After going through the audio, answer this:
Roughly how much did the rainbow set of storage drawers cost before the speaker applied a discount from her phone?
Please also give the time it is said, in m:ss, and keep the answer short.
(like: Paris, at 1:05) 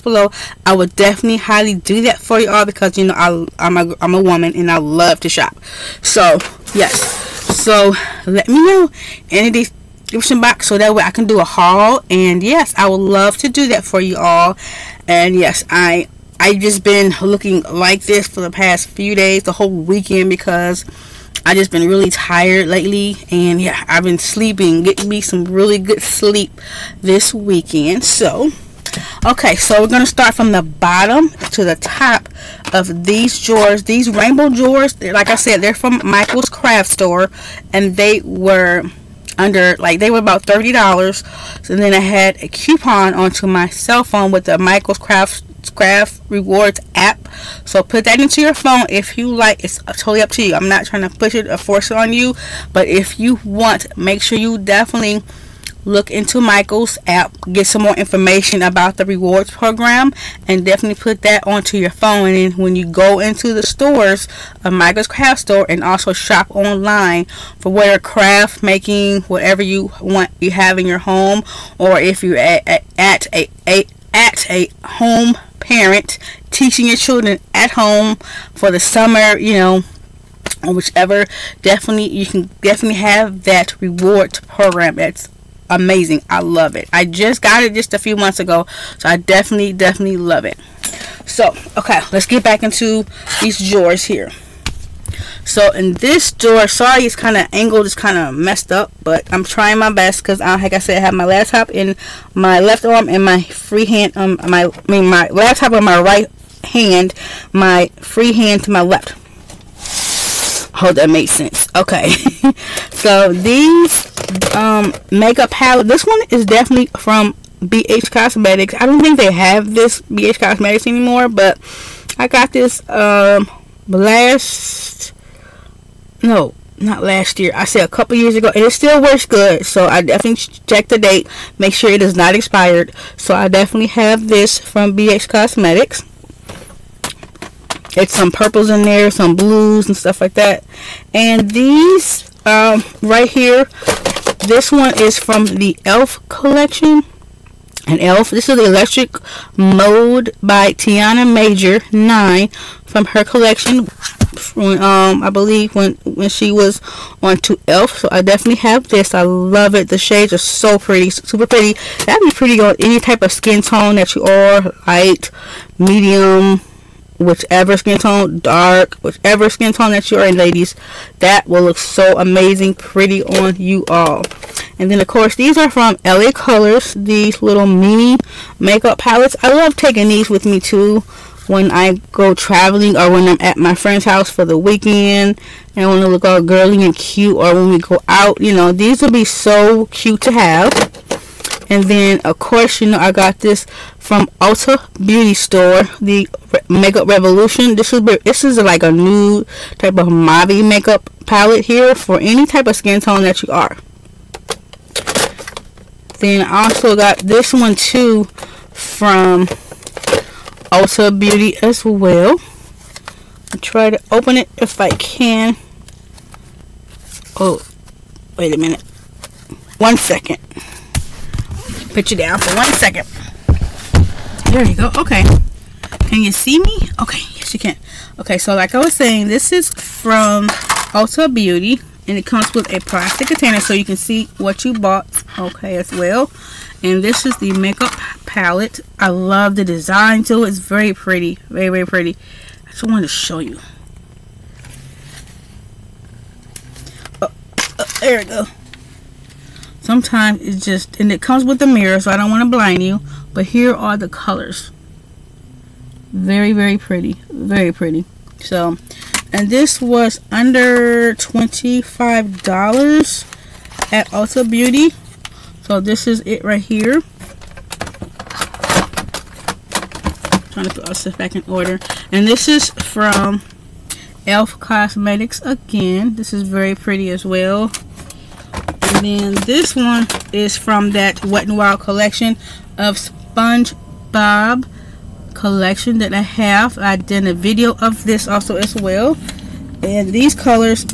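$30, at 0:40.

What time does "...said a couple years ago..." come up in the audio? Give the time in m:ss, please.
2:07.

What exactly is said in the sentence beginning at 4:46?
I did a video of this also as well.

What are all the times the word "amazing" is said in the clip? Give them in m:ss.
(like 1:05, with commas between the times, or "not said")
1:25, 2:52.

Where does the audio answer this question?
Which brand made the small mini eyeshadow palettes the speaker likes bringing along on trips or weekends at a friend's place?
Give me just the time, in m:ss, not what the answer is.
2:56.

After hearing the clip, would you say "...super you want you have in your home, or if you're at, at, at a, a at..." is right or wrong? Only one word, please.
wrong.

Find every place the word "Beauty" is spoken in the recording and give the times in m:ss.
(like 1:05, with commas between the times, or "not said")
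3:15, 3:31, 3:51, 4:24.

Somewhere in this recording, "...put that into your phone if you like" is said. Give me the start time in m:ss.
0:47.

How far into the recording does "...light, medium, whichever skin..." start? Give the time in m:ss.
2:44.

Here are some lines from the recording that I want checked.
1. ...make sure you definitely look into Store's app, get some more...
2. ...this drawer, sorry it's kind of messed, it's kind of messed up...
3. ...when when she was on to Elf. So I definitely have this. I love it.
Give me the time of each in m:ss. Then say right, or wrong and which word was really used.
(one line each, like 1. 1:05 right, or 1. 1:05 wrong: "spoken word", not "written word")
1. 0:53 wrong: "Michael", not "Store"
2. 1:35 wrong: "angled", not "messed"
3. 2:35 right.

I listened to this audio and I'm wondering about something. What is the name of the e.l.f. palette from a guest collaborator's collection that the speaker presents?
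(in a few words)
Electric Mode.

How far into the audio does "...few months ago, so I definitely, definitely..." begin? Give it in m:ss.
1:27.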